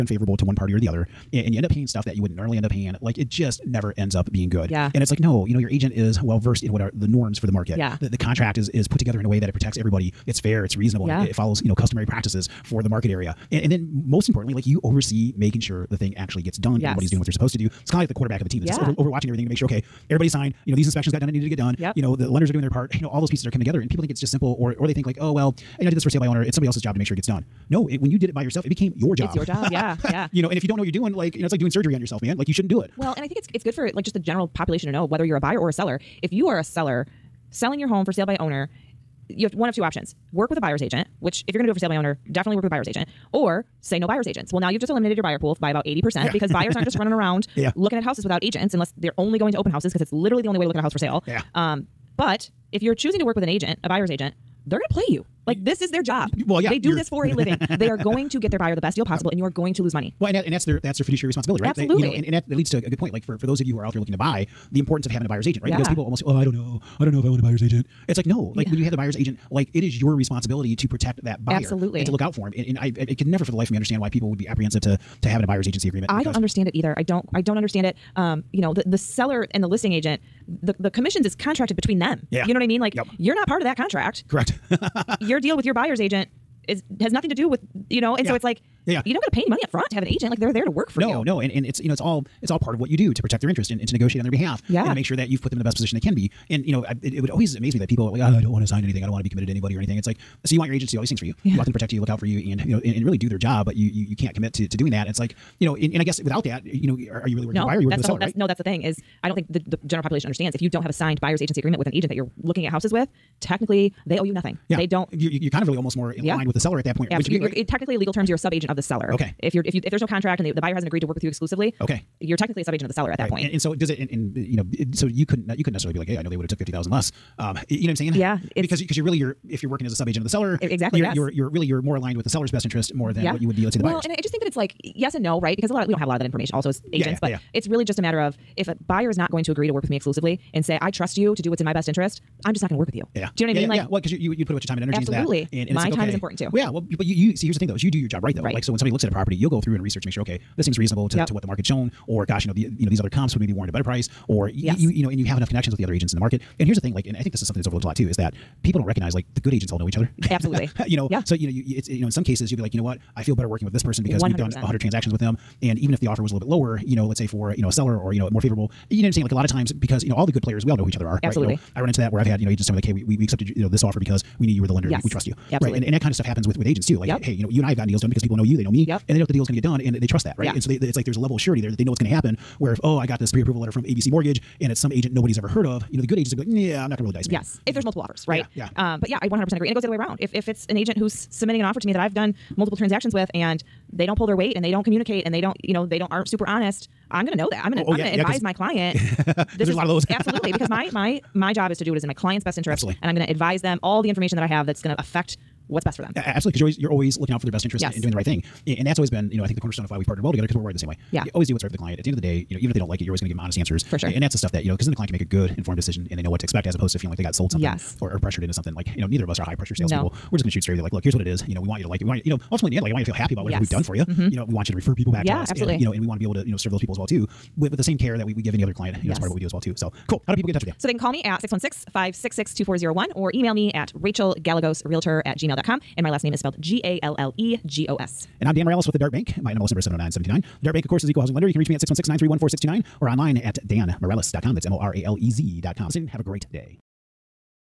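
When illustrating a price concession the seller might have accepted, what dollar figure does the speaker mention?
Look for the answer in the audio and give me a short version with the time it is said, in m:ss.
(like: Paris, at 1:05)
$50,000, at 2:06.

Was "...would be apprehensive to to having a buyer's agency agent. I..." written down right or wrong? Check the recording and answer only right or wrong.
wrong.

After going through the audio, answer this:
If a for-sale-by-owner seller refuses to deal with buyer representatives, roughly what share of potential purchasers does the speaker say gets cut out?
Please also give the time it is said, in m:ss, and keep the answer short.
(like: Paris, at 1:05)
80%, at 0:45.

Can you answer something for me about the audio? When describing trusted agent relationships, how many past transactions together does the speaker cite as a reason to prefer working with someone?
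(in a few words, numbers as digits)
100.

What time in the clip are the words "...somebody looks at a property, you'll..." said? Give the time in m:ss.
2:28.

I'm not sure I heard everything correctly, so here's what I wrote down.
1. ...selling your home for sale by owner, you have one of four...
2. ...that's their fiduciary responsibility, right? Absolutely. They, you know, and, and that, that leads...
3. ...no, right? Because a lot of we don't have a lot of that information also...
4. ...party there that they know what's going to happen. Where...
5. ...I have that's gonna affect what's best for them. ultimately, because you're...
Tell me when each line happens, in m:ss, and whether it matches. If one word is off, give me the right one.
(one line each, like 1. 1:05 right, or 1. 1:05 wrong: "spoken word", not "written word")
1. 0:37 wrong: "two", not "four"
2. 1:00 right
3. 2:15 right
4. 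3:01 wrong: "security", not "party"
5. 3:24 wrong: "absolutely", not "ultimately".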